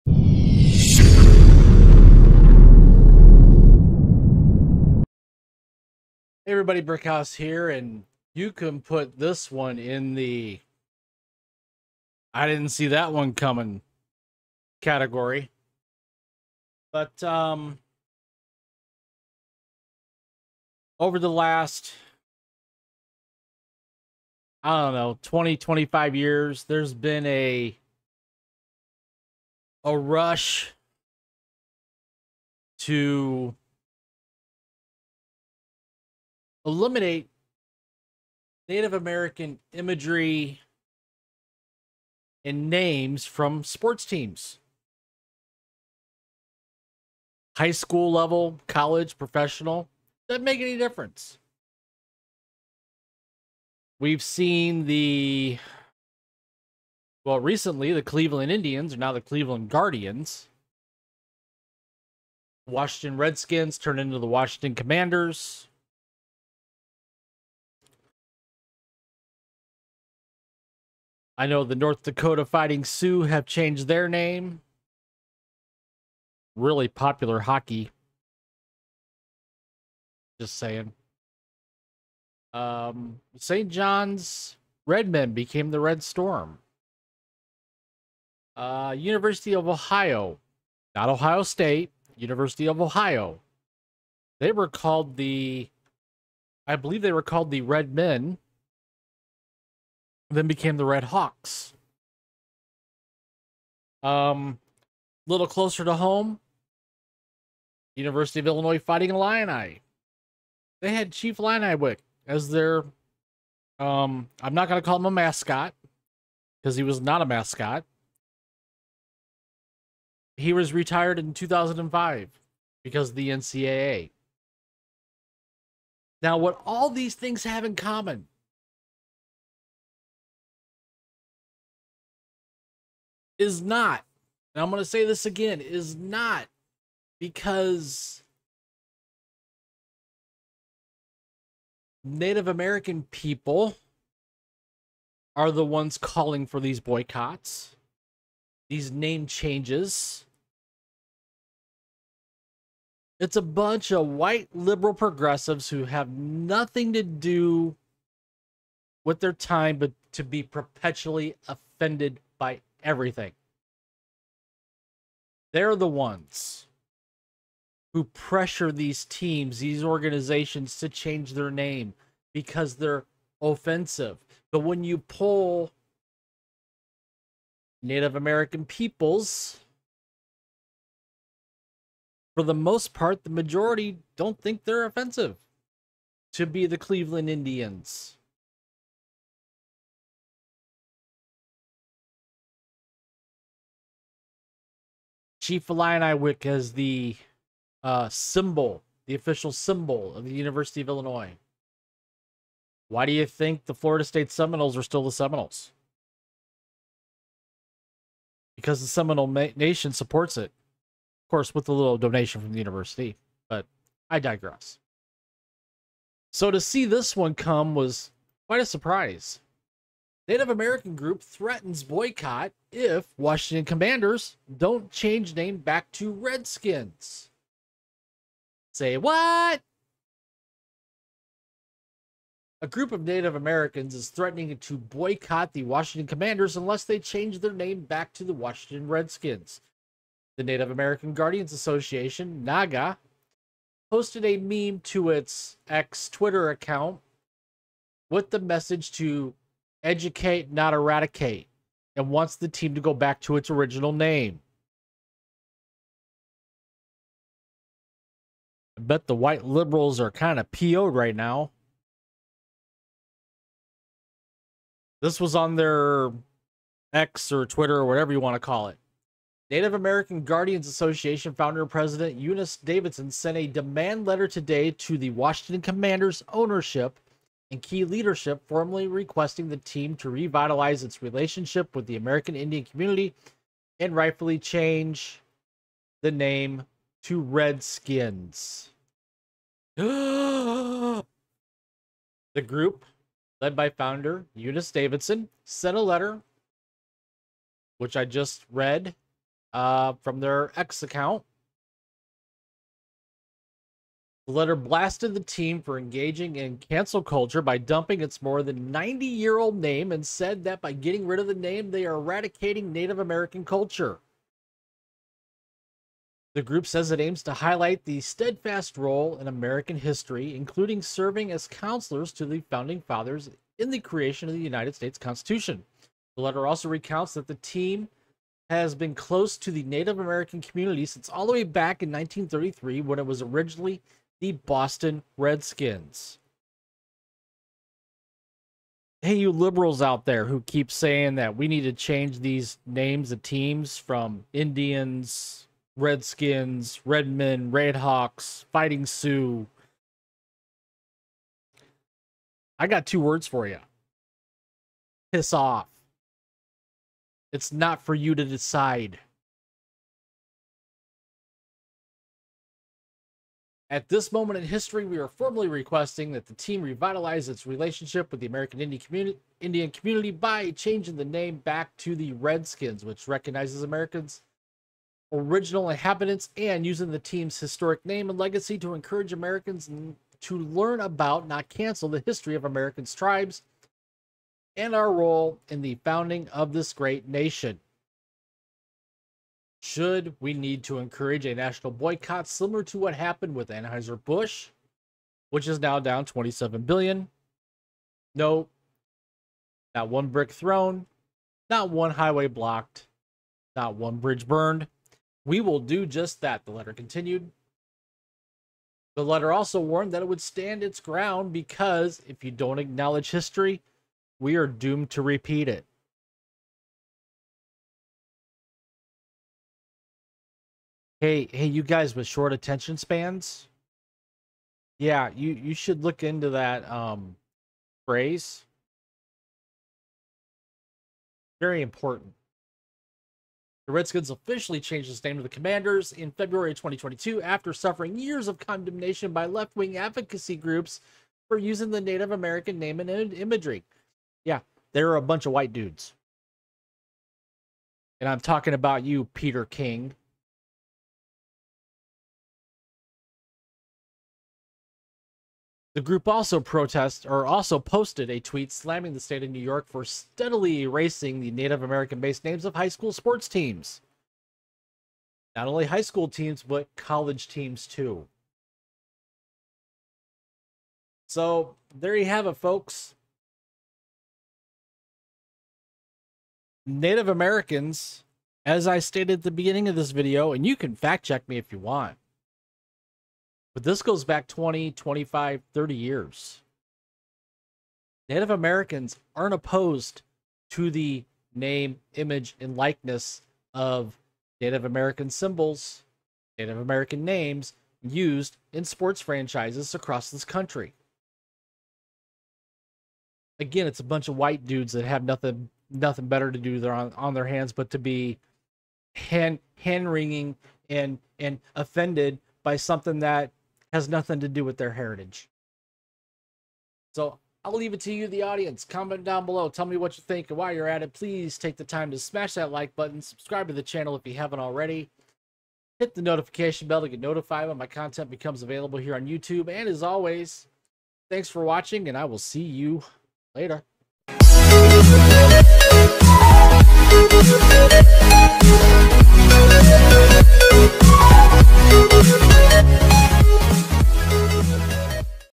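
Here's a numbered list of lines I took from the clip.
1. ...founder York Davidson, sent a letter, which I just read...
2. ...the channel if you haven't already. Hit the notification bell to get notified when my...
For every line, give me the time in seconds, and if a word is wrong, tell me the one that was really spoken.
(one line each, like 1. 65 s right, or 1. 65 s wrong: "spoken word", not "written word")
1. 293 s wrong: "Eunice", not "York"
2. 523 s right.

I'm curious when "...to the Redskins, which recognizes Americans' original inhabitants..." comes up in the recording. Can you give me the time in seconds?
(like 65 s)
371 s.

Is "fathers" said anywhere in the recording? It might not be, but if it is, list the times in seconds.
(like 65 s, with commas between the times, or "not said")
322 s.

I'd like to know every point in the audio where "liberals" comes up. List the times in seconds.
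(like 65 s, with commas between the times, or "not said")
154 s, 259 s, 339 s.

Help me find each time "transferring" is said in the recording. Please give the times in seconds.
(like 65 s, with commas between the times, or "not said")
not said.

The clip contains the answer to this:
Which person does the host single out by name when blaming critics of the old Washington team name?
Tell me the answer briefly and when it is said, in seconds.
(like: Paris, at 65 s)
Peter King, at 449 s.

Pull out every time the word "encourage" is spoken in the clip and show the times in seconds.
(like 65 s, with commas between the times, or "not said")
378 s, 390 s.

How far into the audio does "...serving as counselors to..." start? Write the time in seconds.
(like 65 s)
320 s.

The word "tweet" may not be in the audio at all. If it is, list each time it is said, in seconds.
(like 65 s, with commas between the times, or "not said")
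458 s.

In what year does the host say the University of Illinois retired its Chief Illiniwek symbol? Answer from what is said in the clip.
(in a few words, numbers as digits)
2005.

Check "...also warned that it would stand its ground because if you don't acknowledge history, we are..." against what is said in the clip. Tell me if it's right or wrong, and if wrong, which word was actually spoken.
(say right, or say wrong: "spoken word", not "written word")
right.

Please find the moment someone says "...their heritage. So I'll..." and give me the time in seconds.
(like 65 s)
514 s.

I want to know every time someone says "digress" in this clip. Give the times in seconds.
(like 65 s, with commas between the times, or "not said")
214 s.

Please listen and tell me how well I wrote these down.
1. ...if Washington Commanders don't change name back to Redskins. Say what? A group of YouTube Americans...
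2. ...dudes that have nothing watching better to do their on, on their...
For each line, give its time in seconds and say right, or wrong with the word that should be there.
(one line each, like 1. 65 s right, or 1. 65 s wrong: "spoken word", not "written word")
1. 222 s wrong: "Native", not "YouTube"
2. 504 s wrong: "nothing", not "watching".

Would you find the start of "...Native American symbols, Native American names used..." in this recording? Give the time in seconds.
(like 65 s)
494 s.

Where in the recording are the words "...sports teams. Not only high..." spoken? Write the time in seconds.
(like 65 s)
462 s.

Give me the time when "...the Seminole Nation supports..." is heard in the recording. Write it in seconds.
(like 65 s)
208 s.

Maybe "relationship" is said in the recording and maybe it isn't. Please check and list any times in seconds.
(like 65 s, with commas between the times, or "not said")
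281 s, 367 s.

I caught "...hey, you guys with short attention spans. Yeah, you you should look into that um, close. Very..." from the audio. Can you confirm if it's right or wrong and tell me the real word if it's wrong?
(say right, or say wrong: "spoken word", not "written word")
wrong: "phrase", not "close".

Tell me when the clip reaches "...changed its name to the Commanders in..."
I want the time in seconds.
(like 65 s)
434 s.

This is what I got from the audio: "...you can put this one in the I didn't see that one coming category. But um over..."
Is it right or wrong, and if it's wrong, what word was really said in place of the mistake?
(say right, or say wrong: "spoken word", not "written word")
right.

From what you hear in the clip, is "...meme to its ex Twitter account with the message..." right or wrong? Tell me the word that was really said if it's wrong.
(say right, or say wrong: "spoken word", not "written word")
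right.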